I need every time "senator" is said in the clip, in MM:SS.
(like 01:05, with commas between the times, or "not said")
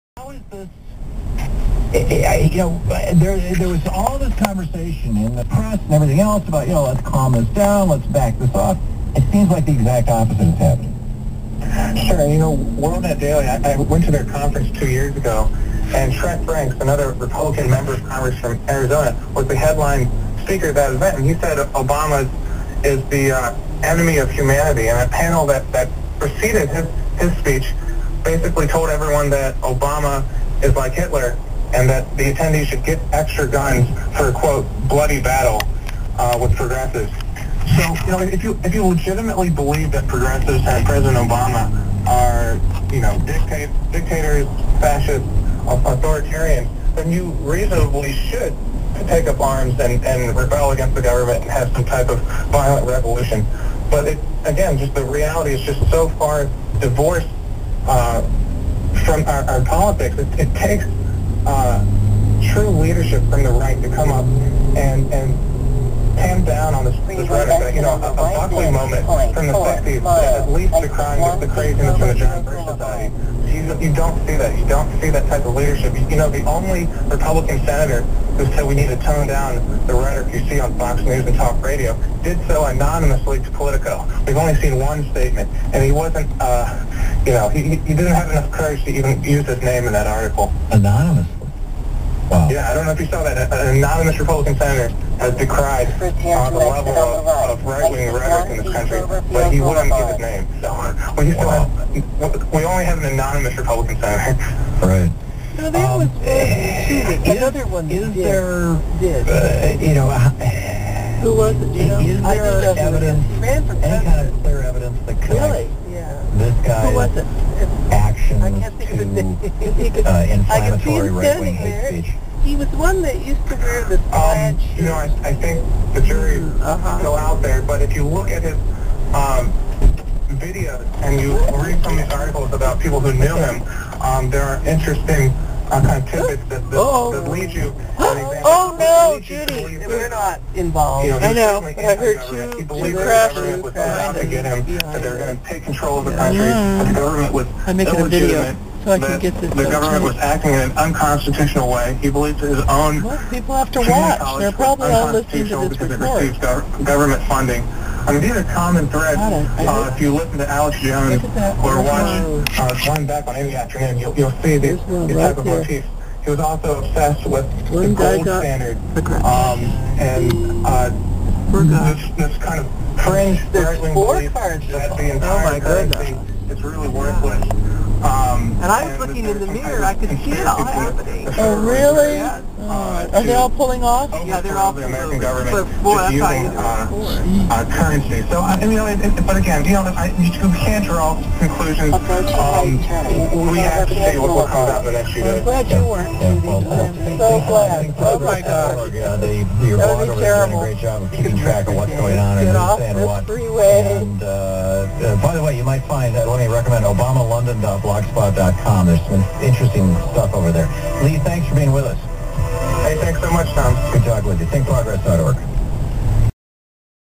01:17, 01:34, 01:43.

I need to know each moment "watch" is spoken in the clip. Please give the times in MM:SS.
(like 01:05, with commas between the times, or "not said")
02:33, 02:41.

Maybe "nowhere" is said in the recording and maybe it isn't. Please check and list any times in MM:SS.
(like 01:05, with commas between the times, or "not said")
not said.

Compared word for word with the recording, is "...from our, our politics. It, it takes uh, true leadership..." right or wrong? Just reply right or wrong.
right.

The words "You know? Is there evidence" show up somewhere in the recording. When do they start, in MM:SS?
01:51.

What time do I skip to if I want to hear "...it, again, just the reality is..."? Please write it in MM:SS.
00:54.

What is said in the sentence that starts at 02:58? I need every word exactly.
Um, um, and I was looking in the mirror.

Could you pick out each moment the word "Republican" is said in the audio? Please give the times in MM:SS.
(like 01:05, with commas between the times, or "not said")
00:17, 01:17, 01:34, 01:43.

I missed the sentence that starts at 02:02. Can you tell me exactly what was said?
He was one that used to wear this um, plaid um, You know, I, I think the jury mm, uh -huh.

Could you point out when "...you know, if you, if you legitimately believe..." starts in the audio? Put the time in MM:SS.
00:38.